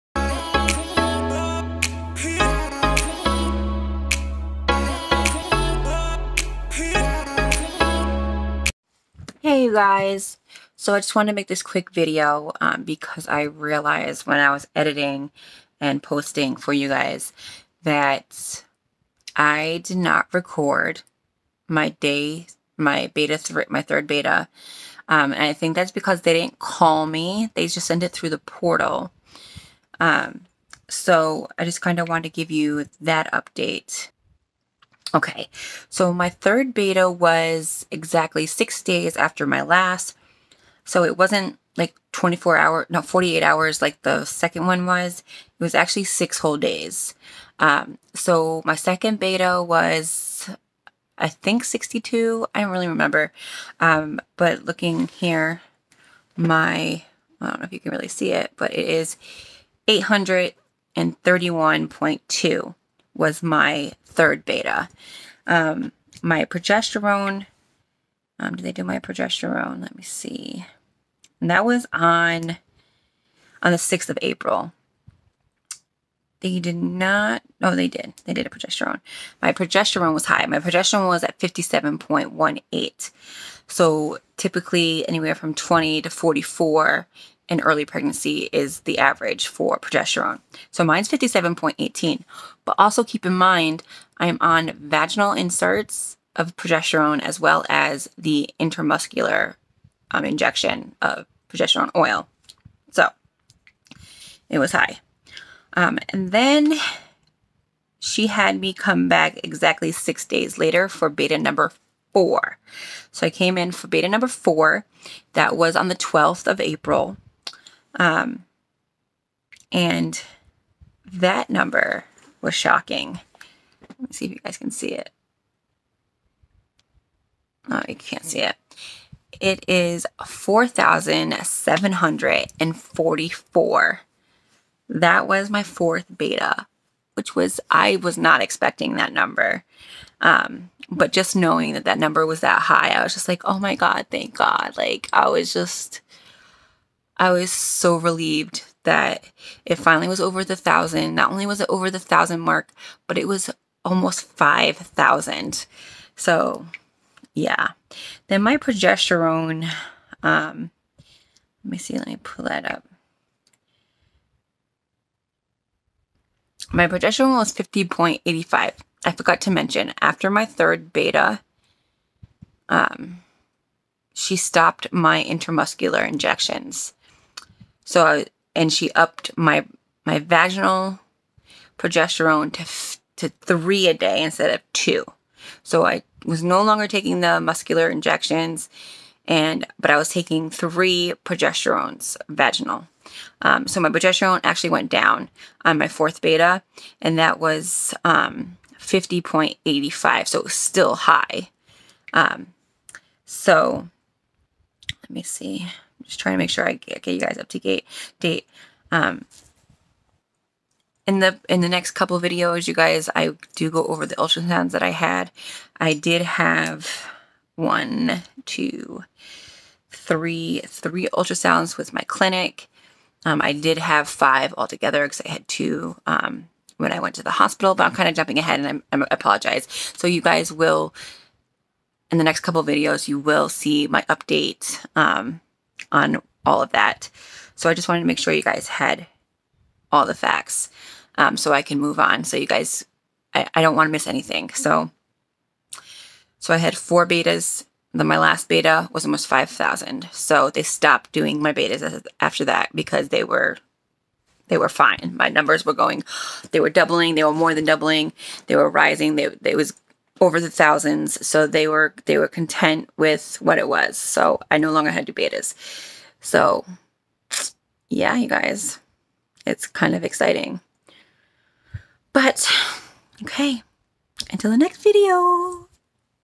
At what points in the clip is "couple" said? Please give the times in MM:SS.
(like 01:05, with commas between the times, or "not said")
03:31, 03:52.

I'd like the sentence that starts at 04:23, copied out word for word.
So I no longer had to betas.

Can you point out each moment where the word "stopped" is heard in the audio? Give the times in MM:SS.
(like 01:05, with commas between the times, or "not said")
02:54, 04:10.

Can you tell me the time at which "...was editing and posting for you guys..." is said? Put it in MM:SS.
00:14.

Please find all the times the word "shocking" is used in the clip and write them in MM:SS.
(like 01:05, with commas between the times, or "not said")
02:02.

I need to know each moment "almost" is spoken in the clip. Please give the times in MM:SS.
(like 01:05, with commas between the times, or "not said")
02:33, 04:09.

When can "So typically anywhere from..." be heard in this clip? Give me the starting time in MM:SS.
01:23.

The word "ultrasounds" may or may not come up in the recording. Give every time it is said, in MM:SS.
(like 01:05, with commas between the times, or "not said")
03:34, 03:41.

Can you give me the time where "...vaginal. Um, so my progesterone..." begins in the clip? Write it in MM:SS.
03:12.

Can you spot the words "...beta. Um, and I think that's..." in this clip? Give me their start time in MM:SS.
00:24.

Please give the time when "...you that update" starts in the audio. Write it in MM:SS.
00:32.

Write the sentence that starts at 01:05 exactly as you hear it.
Um, my progesterone, um, did they do my progesterone?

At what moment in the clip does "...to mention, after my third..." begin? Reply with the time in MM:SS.
02:49.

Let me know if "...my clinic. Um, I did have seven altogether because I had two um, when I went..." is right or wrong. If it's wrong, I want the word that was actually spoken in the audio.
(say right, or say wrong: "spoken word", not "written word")
wrong: "five", not "seven".